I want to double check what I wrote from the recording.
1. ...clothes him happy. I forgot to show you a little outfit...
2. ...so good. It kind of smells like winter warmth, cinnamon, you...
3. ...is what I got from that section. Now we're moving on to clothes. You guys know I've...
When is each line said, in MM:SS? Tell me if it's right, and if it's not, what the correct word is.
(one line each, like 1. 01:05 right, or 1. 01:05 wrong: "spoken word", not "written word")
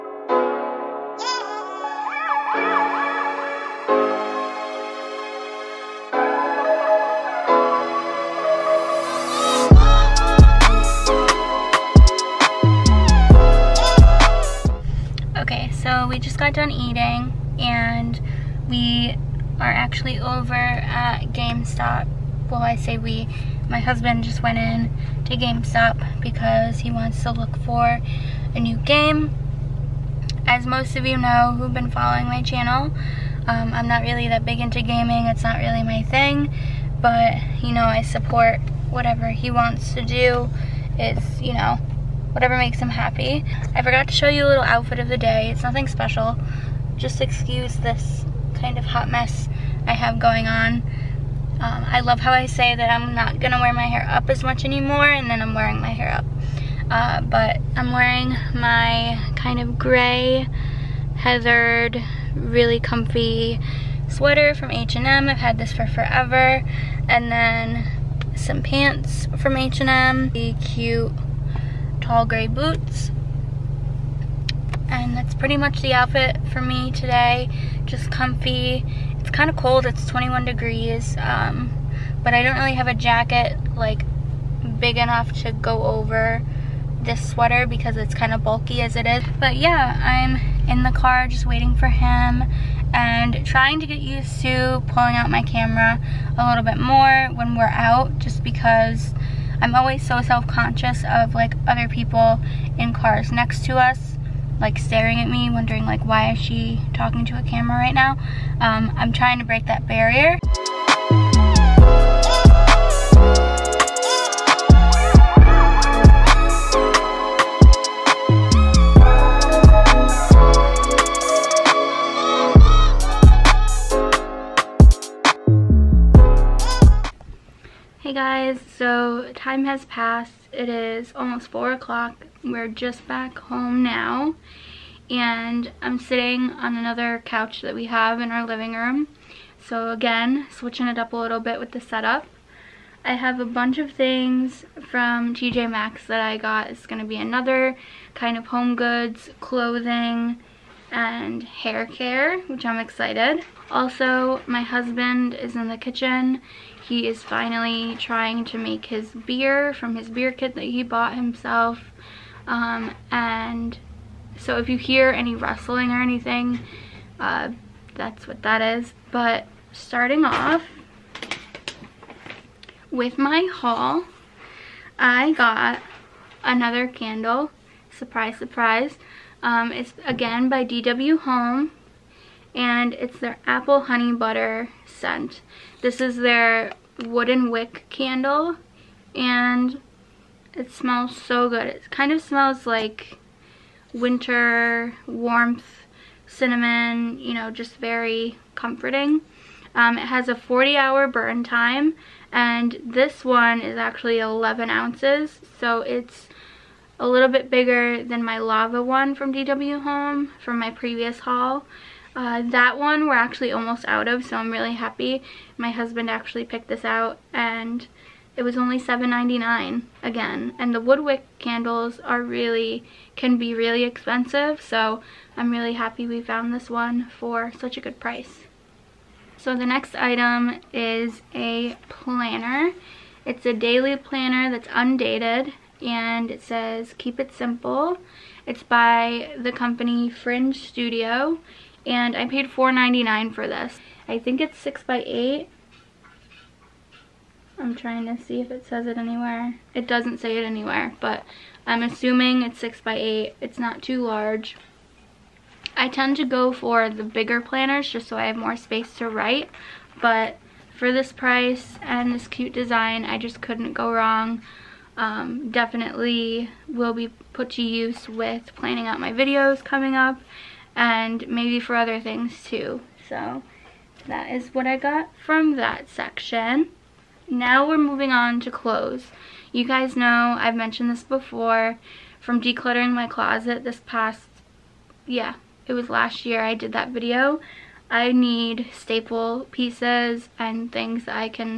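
1. 00:42 wrong: "makes", not "clothes"
2. 03:11 right
3. 04:34 right.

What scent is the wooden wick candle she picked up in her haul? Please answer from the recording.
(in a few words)
Apple honey butter.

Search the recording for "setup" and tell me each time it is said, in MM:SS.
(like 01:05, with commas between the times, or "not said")
02:21.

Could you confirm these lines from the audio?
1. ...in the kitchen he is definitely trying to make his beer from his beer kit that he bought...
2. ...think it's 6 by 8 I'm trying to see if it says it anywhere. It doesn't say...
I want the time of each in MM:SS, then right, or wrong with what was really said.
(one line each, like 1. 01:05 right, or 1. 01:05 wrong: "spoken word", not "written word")
1. 02:35 wrong: "finally", not "definitely"
2. 04:04 right.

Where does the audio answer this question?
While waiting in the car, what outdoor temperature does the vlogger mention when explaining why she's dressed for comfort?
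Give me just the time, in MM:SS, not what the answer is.
01:20.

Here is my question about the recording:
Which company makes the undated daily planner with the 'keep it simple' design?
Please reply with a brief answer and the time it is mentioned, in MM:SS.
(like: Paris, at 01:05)
Fringe Studio, at 04:00.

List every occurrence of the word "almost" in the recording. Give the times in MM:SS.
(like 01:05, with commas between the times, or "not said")
02:11, 03:33.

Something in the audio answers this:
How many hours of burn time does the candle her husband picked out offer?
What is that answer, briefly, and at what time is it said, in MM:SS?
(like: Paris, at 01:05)
40 hours, at 03:20.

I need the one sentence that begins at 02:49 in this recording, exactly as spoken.
But starting off with my haul, I got another candle.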